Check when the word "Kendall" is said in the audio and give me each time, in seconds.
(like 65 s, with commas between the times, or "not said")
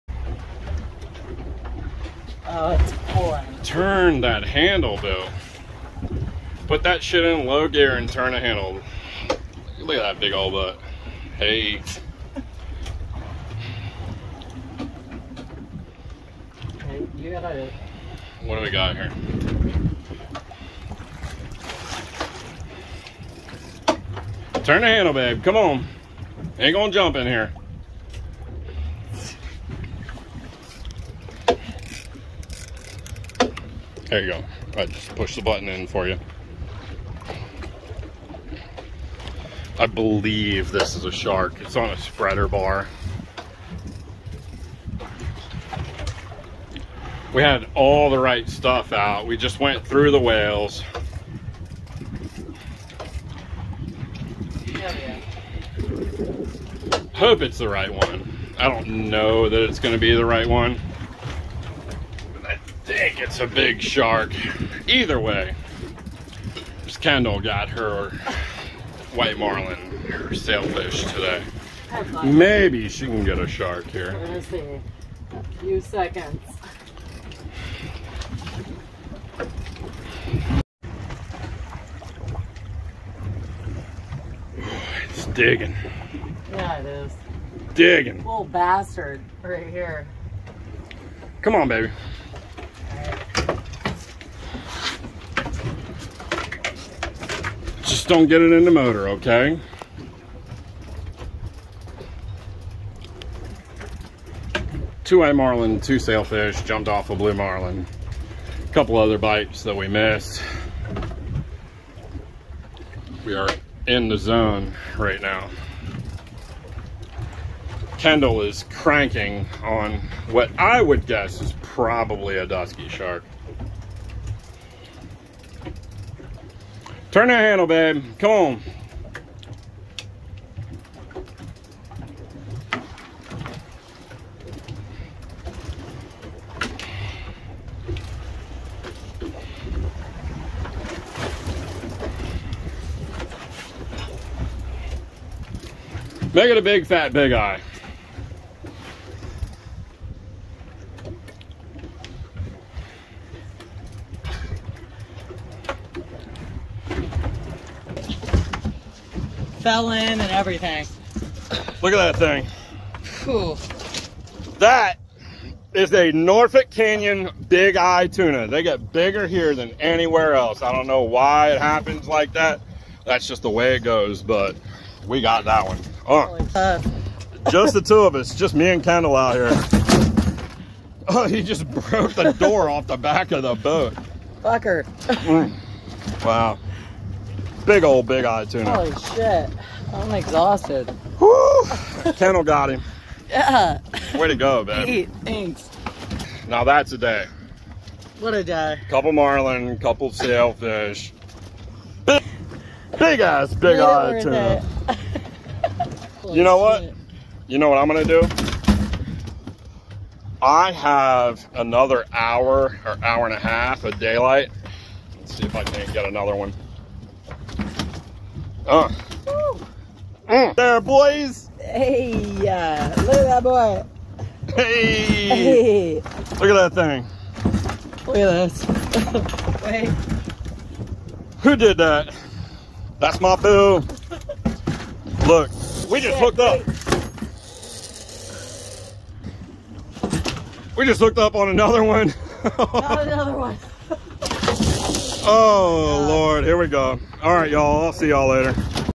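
66 s, 117 s, 178 s, 192 s.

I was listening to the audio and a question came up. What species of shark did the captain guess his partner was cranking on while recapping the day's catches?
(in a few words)
Dusky shark.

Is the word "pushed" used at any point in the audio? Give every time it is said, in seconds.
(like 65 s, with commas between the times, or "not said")
35 s.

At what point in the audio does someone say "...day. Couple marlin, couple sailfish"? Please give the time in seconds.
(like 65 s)
198 s.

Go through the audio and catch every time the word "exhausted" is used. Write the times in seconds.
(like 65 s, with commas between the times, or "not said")
190 s.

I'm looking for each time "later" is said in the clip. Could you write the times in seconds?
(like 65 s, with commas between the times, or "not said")
203 s, 248 s.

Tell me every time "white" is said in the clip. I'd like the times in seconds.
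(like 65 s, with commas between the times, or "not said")
69 s, 105 s.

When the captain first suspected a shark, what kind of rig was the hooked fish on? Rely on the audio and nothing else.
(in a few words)
Spreader bar.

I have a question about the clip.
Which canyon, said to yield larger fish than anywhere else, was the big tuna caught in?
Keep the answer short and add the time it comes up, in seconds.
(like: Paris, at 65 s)
Norfolk Canyon, at 166 s.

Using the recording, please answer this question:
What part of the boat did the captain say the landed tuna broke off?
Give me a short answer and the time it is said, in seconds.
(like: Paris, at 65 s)
The door, at 182 s.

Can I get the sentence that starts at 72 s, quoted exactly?
Maybe she can get a shark here.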